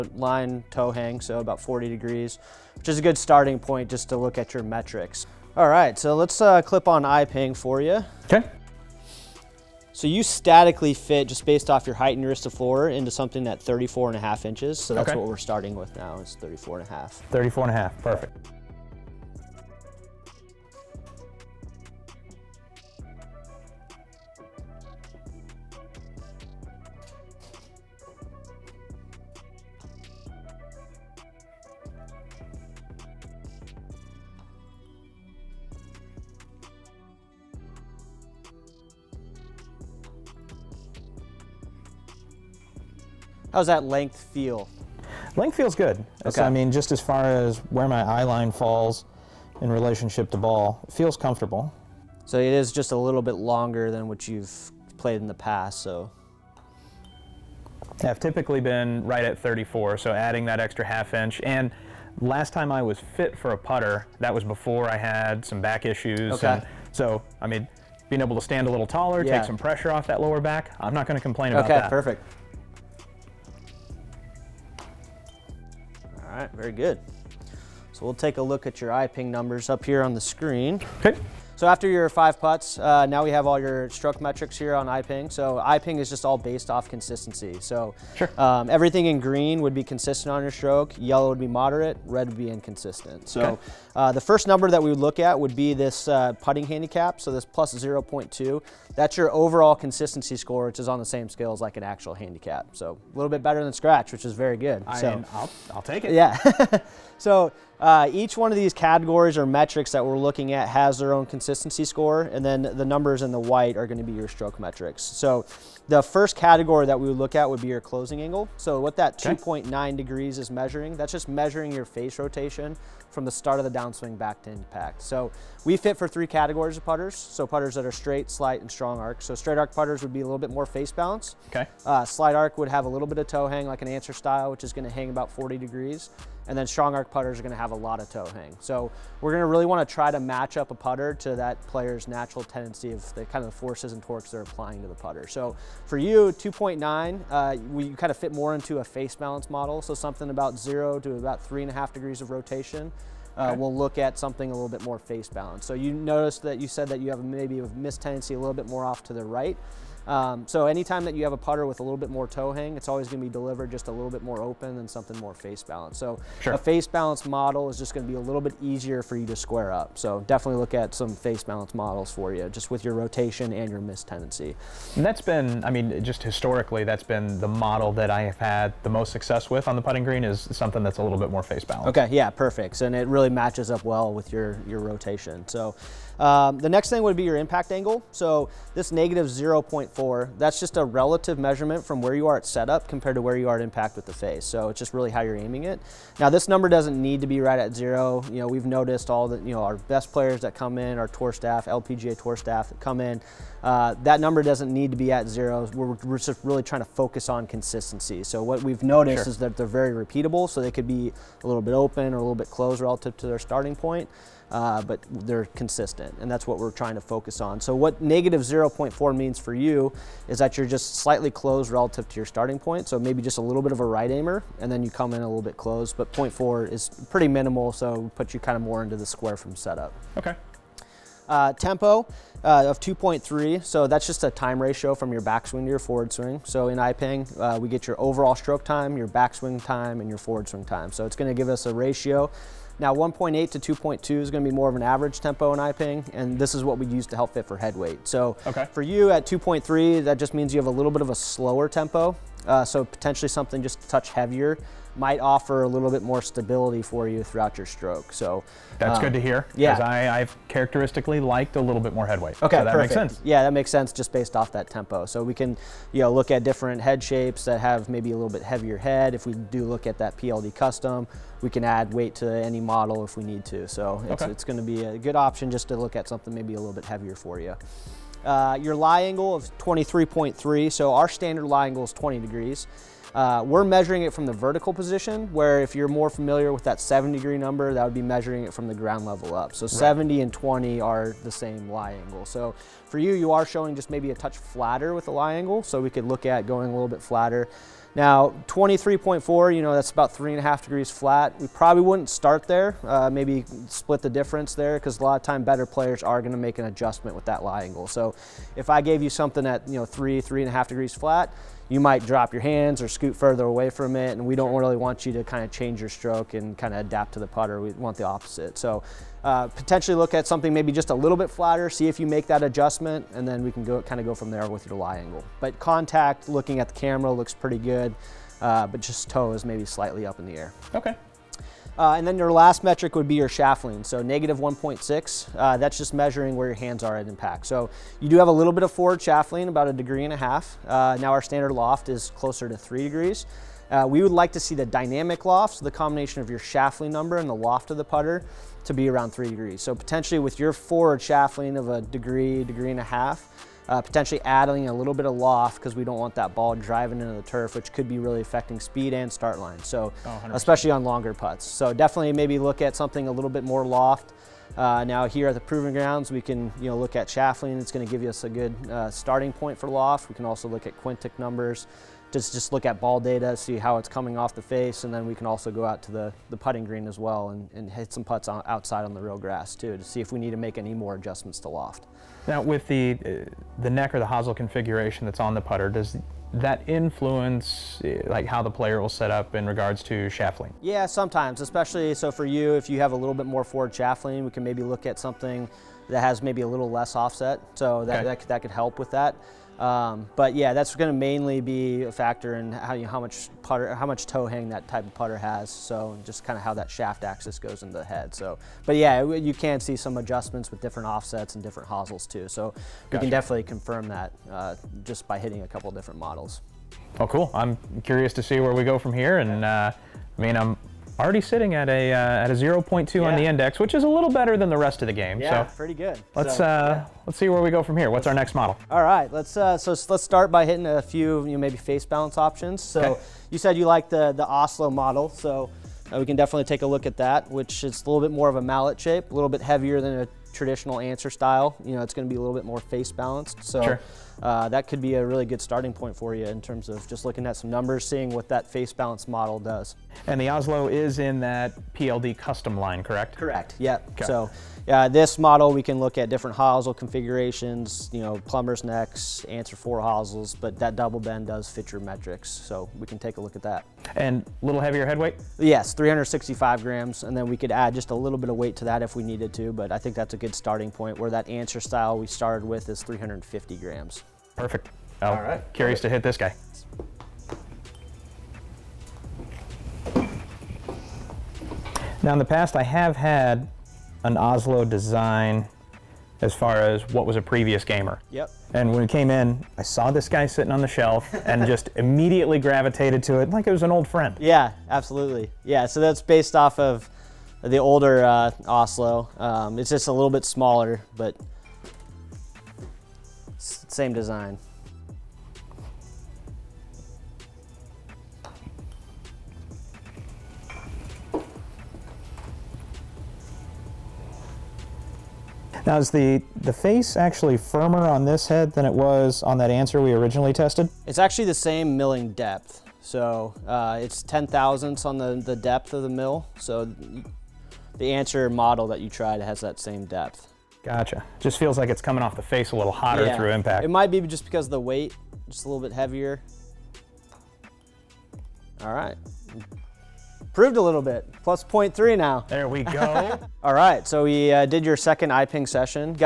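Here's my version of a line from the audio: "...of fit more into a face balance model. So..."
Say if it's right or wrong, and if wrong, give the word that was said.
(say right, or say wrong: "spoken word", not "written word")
right.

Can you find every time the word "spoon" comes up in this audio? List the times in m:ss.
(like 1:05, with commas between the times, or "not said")
not said.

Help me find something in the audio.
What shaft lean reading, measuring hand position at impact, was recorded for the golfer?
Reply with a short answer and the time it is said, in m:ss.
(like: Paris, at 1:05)
-1.6, at 5:34.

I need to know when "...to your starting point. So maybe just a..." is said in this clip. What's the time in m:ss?
3:42.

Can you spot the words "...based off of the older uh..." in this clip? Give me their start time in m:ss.
8:16.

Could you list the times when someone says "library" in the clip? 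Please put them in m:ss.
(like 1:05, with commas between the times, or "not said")
not said.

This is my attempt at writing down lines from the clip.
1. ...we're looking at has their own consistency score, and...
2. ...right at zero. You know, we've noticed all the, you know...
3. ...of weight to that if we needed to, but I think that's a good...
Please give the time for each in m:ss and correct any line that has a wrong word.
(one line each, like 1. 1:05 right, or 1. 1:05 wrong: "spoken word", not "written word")
1. 1:50 right
2. 3:17 right
3. 7:48 right.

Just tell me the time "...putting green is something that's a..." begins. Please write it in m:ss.
2:59.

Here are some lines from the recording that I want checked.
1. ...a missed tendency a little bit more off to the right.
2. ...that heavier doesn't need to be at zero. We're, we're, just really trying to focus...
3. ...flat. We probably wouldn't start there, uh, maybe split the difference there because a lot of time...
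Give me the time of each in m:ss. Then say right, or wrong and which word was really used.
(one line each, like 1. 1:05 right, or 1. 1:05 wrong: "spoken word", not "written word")
1. 2:37 right
2. 3:24 wrong: "number", not "heavier"
3. 5:00 right.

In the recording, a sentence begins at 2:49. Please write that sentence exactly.
So definitely look at some face balanced models for you, just with your rotation and your miss tendency.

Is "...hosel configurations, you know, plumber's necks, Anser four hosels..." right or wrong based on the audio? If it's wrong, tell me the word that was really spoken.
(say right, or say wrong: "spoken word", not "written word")
right.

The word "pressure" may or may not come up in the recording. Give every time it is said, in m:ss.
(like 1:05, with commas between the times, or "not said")
1:09.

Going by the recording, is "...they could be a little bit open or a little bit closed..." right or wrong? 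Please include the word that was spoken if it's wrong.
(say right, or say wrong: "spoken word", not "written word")
right.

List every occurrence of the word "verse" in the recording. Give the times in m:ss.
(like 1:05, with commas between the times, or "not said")
not said.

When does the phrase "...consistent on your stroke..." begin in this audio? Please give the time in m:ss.
1:29.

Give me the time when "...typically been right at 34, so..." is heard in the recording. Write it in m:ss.
0:58.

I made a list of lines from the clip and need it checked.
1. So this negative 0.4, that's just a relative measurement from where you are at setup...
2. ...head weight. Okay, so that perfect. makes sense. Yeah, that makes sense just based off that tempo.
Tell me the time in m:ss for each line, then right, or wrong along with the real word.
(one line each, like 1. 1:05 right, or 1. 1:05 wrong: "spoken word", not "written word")
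1. 3:08 right
2. 4:22 right.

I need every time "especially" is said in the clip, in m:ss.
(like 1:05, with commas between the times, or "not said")
6:00, 6:31.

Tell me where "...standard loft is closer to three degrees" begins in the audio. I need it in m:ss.
5:41.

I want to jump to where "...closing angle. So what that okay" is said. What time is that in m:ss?
1:57.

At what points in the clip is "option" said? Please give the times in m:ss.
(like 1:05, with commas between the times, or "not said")
4:35, 7:12.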